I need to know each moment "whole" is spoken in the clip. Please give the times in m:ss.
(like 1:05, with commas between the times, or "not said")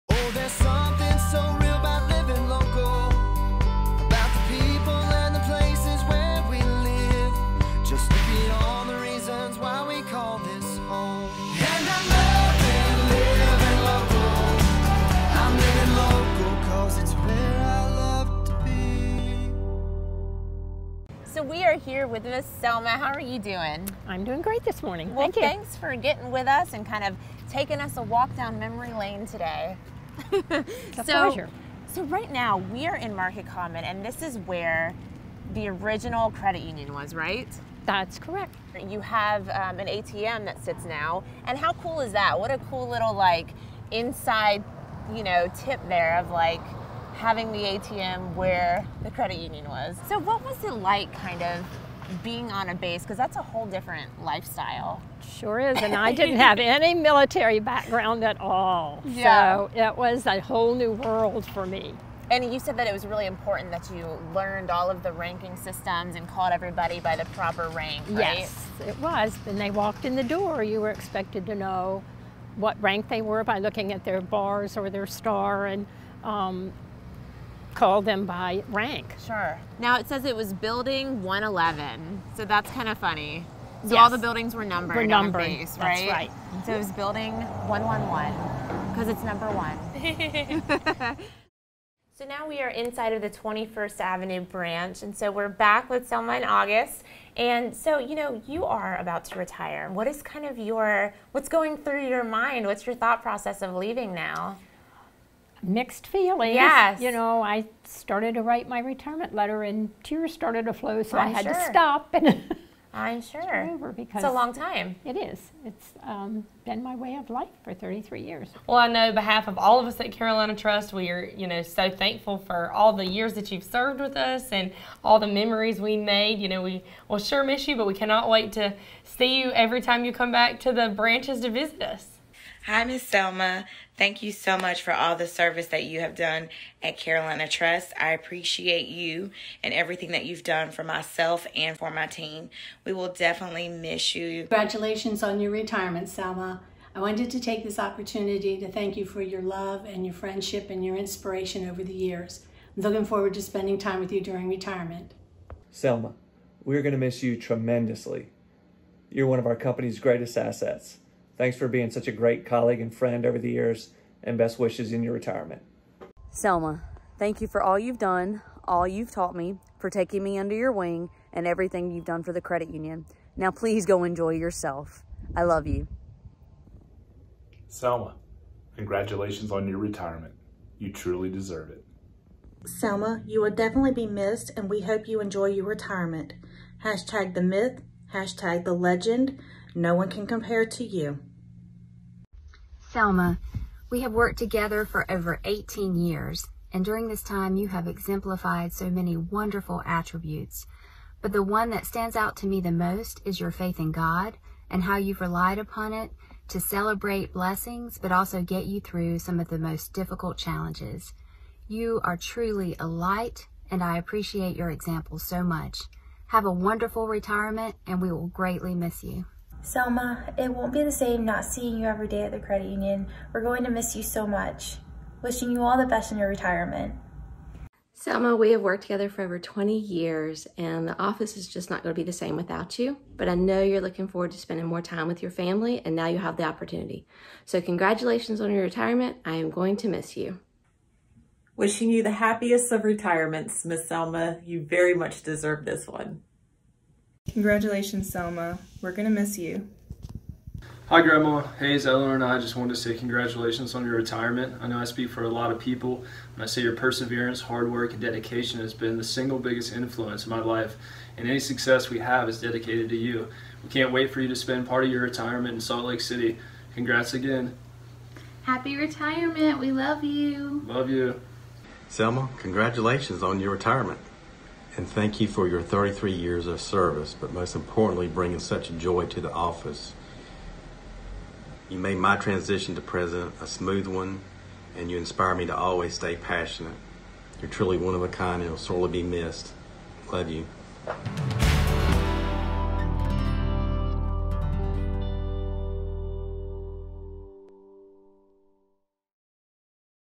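0:53, 1:00.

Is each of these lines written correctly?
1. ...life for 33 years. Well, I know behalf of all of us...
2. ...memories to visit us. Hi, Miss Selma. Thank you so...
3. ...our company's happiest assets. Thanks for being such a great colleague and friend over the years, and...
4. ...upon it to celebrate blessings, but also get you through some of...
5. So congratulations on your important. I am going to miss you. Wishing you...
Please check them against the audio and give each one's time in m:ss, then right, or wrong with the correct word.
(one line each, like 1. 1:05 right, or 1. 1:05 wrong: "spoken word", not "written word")
1. 1:57 right
2. 2:10 wrong: "branches", not "memories"
3. 2:39 wrong: "greatest", not "happiest"
4. 3:25 right
5. 3:57 wrong: "retirement", not "important".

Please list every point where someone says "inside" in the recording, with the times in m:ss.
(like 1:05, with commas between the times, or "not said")
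0:43, 1:32.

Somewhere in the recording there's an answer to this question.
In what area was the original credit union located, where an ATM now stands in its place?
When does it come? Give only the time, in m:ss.
0:33.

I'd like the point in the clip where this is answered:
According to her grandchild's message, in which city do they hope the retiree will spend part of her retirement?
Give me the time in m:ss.
4:25.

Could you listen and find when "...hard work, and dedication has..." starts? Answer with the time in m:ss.
4:17.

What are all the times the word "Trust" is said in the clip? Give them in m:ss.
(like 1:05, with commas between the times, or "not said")
2:00, 2:17.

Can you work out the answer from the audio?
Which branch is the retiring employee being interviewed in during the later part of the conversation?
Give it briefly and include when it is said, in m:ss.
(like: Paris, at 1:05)
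21st Avenue branch, at 1:33.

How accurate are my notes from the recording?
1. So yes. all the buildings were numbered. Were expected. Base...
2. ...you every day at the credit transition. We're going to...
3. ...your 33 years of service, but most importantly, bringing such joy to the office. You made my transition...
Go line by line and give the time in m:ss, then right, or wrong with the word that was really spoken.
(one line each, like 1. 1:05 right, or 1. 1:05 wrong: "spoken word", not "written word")
1. 1:23 wrong: "numbered", not "expected"
2. 3:41 wrong: "union", not "transition"
3. 4:35 right.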